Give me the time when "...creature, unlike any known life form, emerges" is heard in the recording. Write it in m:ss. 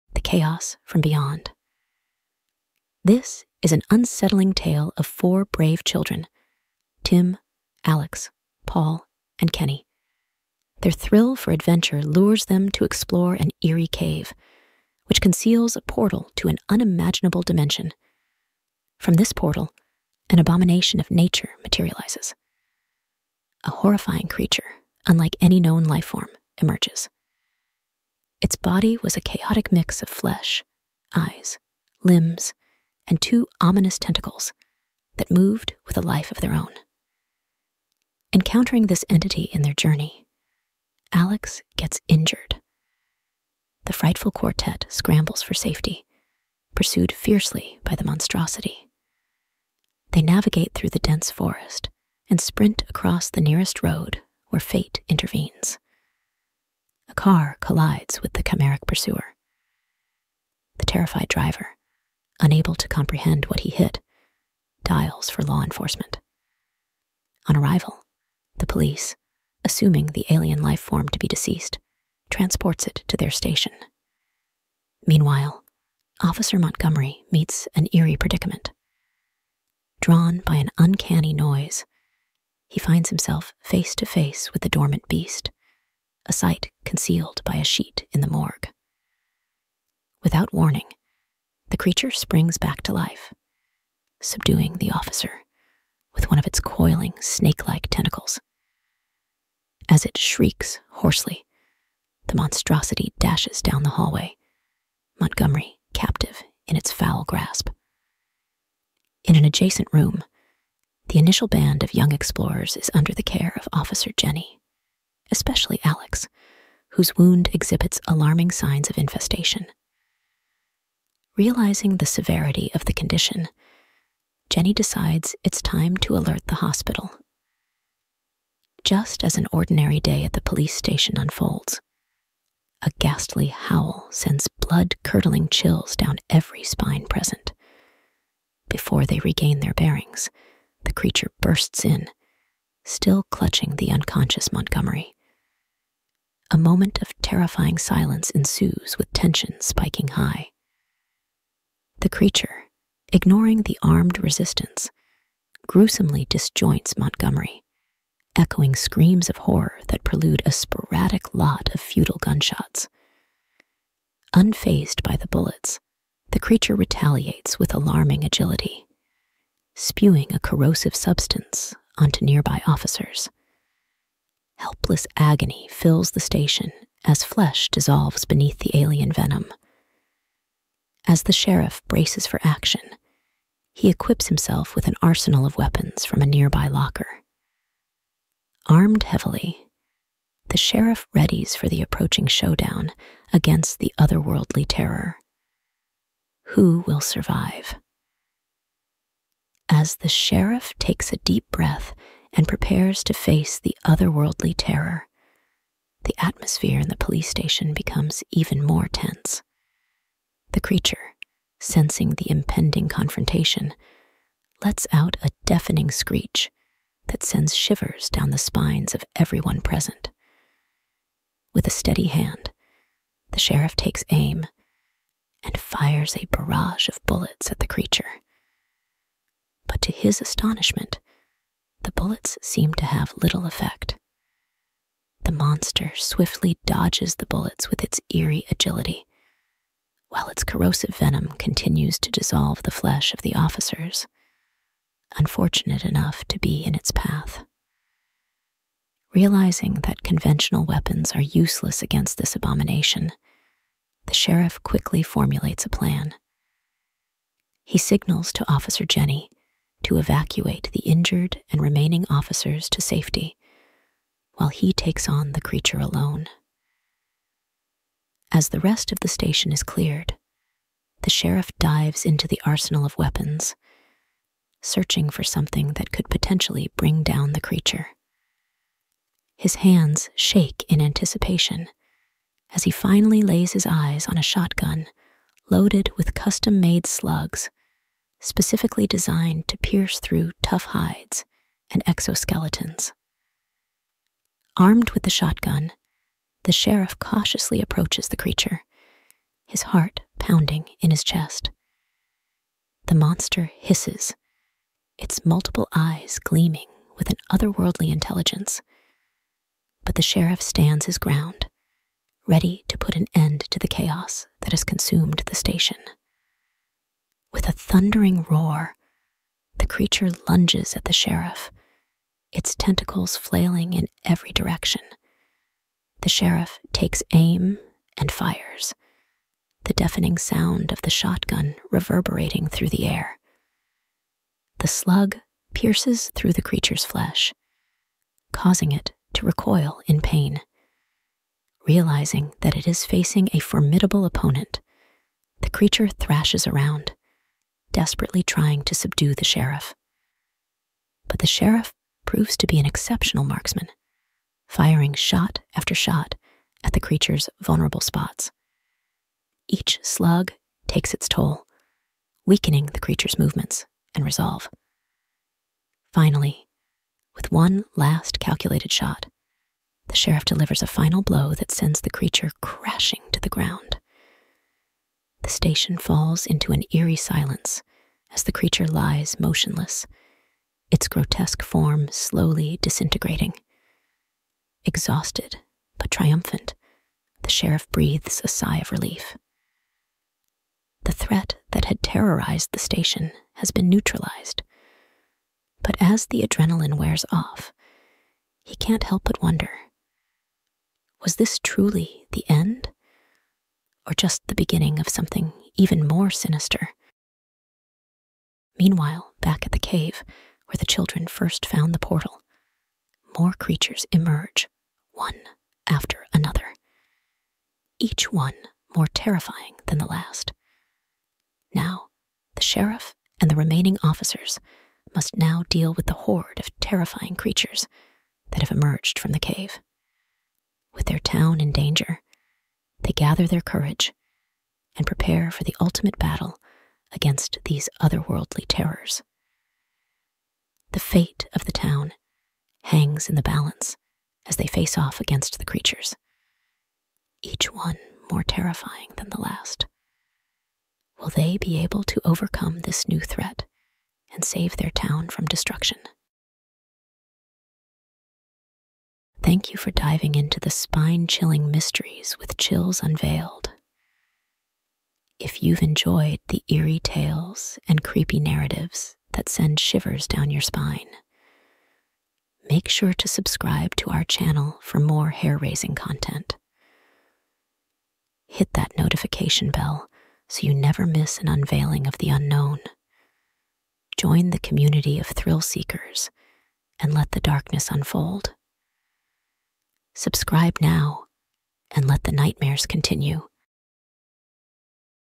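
0:24.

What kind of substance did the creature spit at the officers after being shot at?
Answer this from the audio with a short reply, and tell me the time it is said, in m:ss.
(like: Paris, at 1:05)
corrosive substance, at 2:50.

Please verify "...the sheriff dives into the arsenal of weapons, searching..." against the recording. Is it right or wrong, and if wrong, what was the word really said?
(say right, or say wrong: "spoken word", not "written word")
right.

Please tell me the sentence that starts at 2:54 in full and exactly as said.
Helpless agony fills the station as flesh dissolves beneath the alien venom.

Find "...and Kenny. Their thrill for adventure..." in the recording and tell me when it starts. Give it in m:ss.
0:09.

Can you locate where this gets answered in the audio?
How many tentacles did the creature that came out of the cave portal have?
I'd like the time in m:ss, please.
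0:33.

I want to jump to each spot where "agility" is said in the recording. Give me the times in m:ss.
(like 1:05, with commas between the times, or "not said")
2:48, 3:58.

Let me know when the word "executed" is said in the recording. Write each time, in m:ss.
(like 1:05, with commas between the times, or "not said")
not said.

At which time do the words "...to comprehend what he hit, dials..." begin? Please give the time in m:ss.
1:02.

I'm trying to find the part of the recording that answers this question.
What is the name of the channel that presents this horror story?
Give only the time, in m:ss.
7:42.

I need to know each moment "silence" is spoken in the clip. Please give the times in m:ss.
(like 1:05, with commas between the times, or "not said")
2:27, 6:16.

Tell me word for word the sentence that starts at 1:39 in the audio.
As it shrieks hoarsely, the monstrosity dashes down the hallway, Montgomery captive in its foul grasp.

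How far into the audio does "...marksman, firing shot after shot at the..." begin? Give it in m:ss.
5:53.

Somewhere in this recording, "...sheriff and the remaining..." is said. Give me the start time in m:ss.
7:02.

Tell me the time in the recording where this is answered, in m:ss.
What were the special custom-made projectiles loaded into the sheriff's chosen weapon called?
4:46.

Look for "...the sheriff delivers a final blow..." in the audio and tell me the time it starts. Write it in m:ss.
6:09.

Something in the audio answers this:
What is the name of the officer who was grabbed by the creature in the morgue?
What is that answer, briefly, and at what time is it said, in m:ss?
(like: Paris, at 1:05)
Officer Montgomery, at 1:16.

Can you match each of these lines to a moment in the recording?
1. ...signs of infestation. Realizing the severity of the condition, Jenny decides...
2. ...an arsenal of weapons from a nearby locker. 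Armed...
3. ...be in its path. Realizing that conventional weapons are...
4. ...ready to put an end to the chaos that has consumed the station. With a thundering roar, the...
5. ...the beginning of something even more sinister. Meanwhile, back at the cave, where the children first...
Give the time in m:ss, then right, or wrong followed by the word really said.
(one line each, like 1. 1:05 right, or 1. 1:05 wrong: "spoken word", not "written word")
1. 1:58 right
2. 3:04 right
3. 4:06 right
4. 5:12 right
5. 6:44 right.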